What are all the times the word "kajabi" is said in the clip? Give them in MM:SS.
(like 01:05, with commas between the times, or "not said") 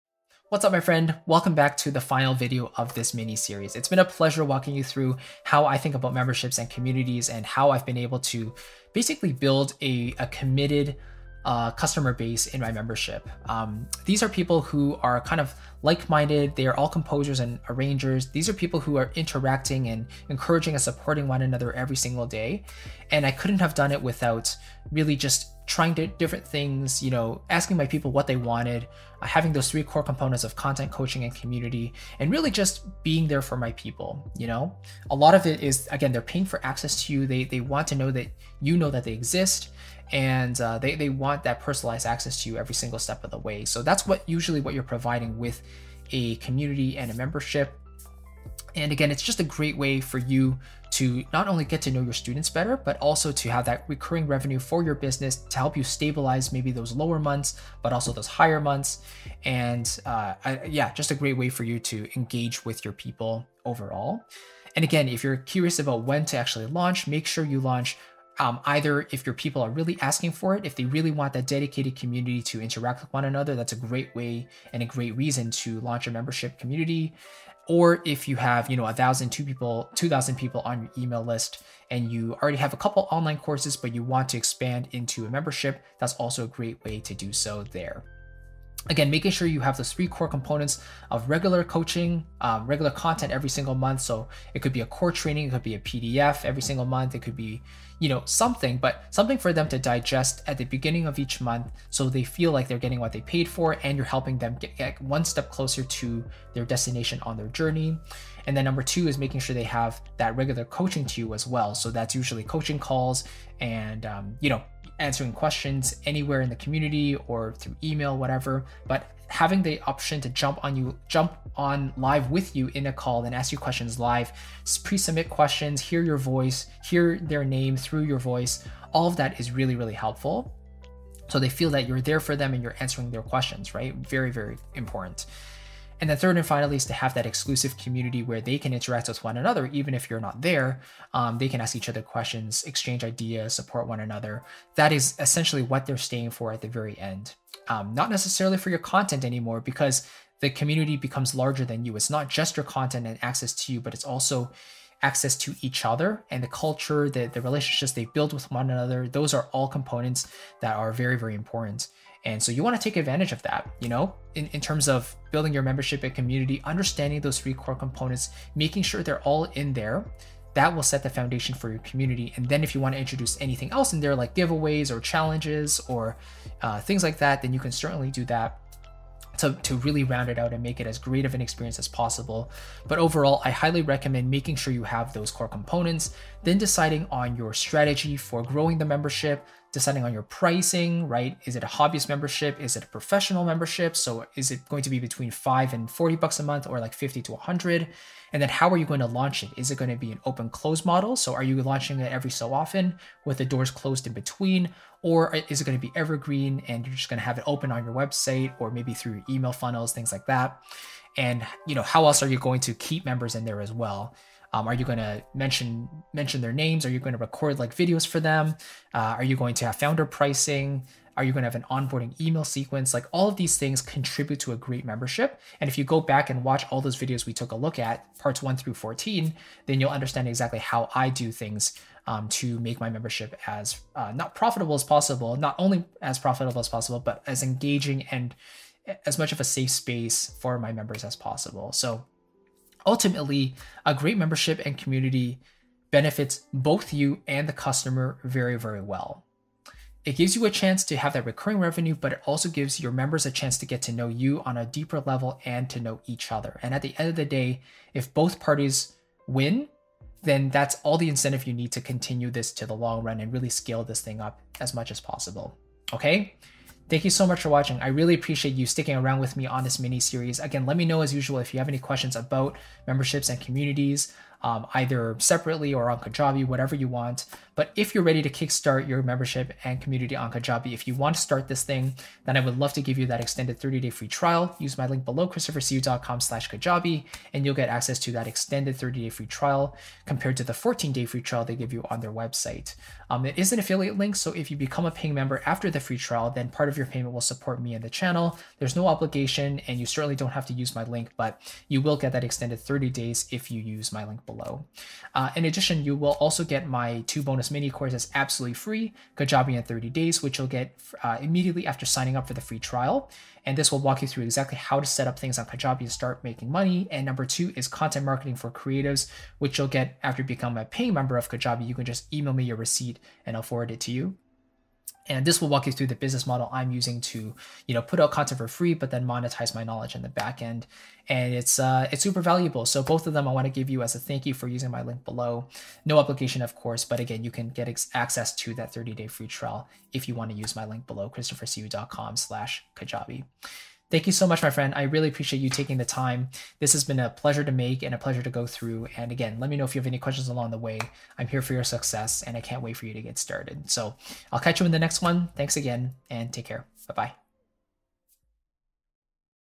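04:35, 04:40, 04:46, 05:09, 05:15, 05:21, 05:42.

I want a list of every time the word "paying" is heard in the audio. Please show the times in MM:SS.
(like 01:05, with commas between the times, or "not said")
00:36, 04:54, 05:20.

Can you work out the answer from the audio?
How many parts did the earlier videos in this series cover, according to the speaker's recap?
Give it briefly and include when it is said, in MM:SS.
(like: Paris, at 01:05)
14, at 03:48.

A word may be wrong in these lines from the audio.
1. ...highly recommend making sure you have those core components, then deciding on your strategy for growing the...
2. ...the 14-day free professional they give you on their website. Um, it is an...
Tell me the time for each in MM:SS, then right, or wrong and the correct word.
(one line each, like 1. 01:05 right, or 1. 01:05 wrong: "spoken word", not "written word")
1. 03:03 right
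2. 04:50 wrong: "trial", not "professional".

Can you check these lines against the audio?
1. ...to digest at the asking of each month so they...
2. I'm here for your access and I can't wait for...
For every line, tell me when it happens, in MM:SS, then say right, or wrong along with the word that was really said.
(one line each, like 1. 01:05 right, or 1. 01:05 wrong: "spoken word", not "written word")
1. 01:39 wrong: "beginning", not "asking"
2. 05:51 wrong: "success", not "access".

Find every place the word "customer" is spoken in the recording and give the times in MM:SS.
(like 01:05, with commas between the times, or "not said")
00:11, 04:07.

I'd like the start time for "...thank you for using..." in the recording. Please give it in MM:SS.
05:33.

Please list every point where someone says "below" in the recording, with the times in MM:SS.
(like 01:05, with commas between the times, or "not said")
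04:45, 05:04, 05:35, 05:40.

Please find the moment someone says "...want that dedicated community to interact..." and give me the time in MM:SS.
01:11.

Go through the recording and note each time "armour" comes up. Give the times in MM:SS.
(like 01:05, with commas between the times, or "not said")
not said.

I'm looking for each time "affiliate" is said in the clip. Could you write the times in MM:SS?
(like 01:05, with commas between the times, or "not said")
04:53.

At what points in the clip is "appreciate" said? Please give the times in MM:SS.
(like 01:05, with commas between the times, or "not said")
04:28, 05:45.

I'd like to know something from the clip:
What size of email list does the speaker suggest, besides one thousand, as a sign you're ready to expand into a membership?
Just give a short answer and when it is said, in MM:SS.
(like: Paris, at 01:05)
2,000 people, at 01:19.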